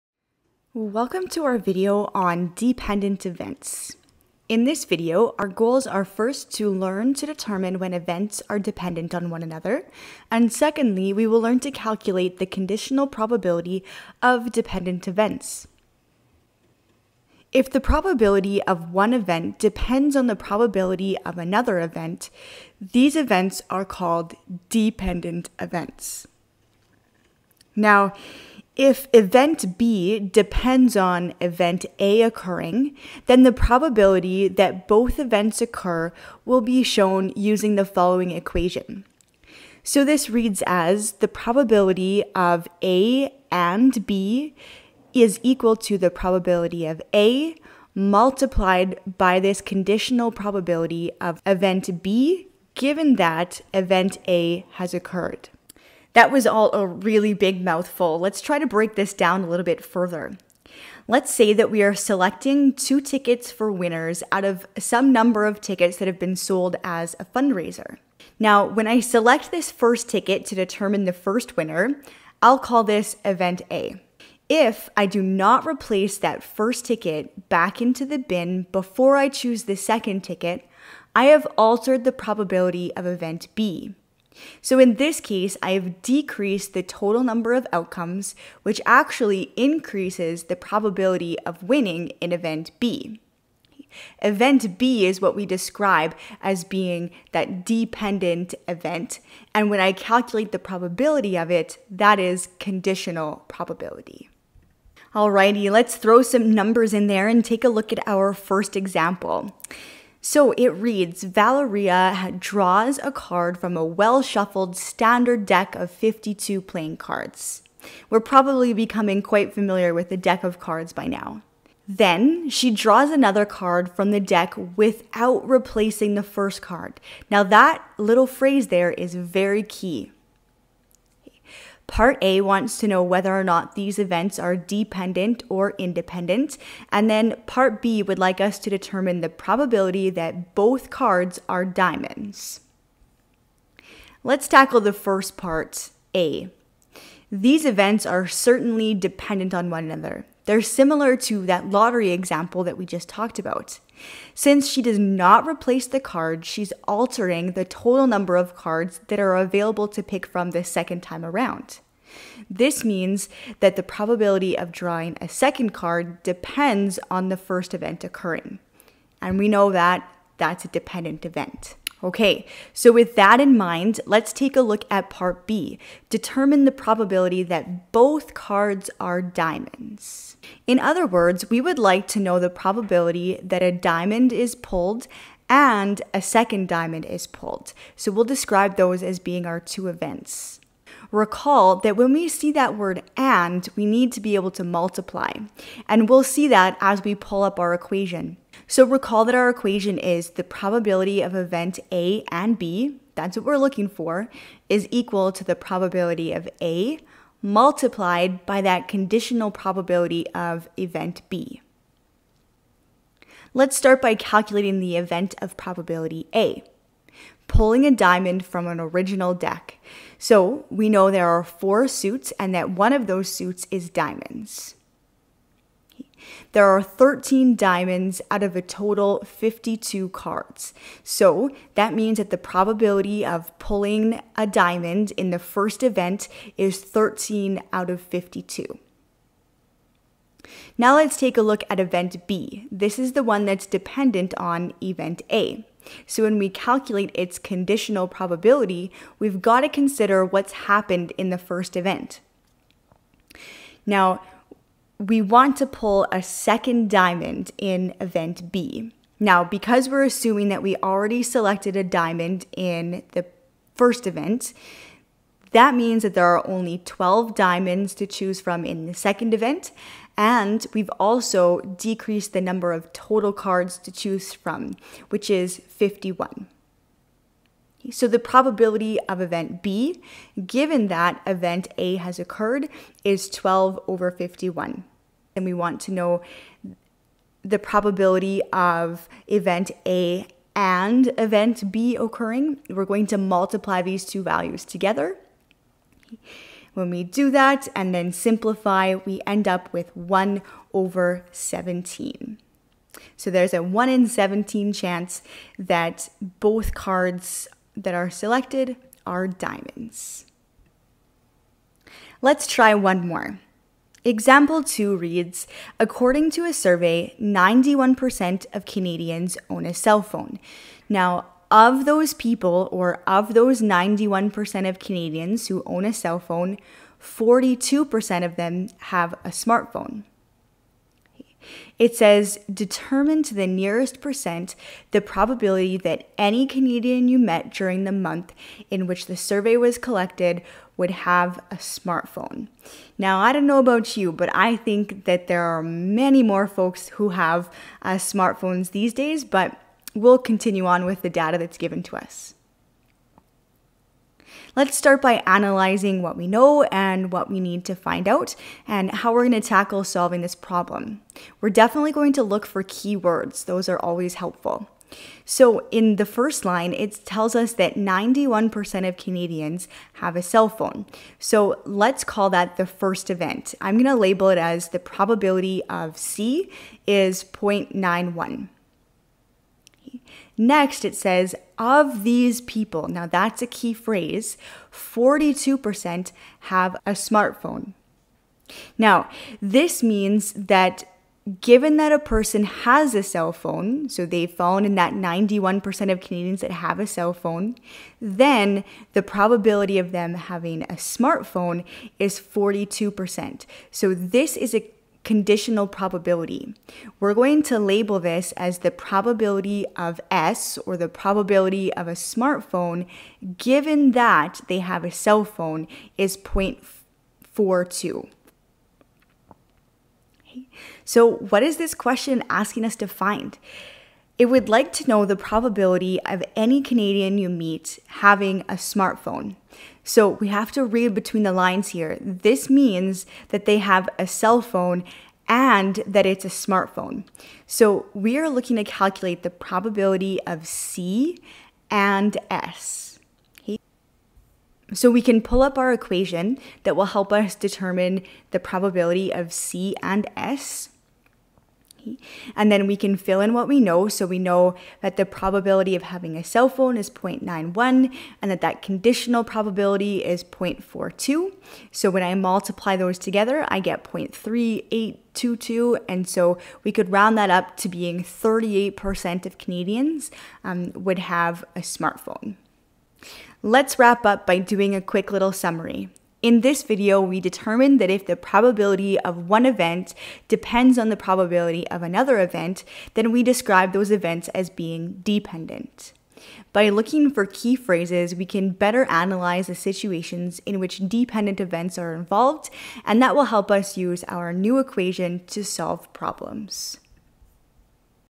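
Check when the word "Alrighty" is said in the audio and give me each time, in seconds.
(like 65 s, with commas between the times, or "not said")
105 s.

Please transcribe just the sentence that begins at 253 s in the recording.
Now, we want to pull a second diamond in event B.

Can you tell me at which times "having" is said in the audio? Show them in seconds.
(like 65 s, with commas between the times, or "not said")
400 s, 427 s, 455 s.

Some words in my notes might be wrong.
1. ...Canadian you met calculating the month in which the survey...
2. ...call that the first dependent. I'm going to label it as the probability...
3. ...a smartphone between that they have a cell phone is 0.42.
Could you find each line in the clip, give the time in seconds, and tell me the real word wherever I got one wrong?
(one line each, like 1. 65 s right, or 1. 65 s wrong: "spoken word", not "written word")
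1. 336 s wrong: "during", not "calculating"
2. 372 s wrong: "event", not "dependent"
3. 411 s wrong: "given", not "between".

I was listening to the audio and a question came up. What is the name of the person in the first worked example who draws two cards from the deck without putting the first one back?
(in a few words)
Valeria.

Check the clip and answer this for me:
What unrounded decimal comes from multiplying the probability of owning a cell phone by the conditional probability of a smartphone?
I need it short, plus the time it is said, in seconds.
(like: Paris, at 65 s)
0.3822, at 463 s.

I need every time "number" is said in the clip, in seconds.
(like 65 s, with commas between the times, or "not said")
65 s, 87 s, 106 s, 158 s, 272 s.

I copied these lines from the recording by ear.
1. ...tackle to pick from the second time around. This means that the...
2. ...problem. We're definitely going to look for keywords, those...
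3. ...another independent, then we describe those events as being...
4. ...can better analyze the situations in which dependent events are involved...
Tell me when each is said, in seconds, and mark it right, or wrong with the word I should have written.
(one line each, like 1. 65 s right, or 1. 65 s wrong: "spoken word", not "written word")
1. 159 s wrong: "available", not "tackle"
2. 360 s right
3. 481 s wrong: "event", not "independent"
4. 488 s right.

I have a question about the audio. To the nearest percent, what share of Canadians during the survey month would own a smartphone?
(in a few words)
38%.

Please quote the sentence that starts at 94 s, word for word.
Event B is what we describe as being that dependent event.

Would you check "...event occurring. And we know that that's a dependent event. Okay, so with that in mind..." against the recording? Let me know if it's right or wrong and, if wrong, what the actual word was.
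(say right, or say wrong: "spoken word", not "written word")
right.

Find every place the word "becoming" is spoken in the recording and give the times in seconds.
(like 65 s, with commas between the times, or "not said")
118 s.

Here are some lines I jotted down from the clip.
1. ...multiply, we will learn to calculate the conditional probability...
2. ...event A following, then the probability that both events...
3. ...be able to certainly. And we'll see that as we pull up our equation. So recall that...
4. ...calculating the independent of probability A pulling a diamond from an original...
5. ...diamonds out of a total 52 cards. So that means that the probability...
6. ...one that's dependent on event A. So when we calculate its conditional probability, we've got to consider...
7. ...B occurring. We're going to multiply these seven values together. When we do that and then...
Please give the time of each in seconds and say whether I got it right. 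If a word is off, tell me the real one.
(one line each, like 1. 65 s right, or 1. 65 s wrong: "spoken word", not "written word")
1. 10 s wrong: "secondly", not "multiply"
2. 31 s wrong: "occurring", not "following"
3. 194 s wrong: "multiply", not "certainly"
4. 214 s wrong: "event", not "independent"
5. 227 s right
6. 243 s right
7. 291 s wrong: "two", not "seven".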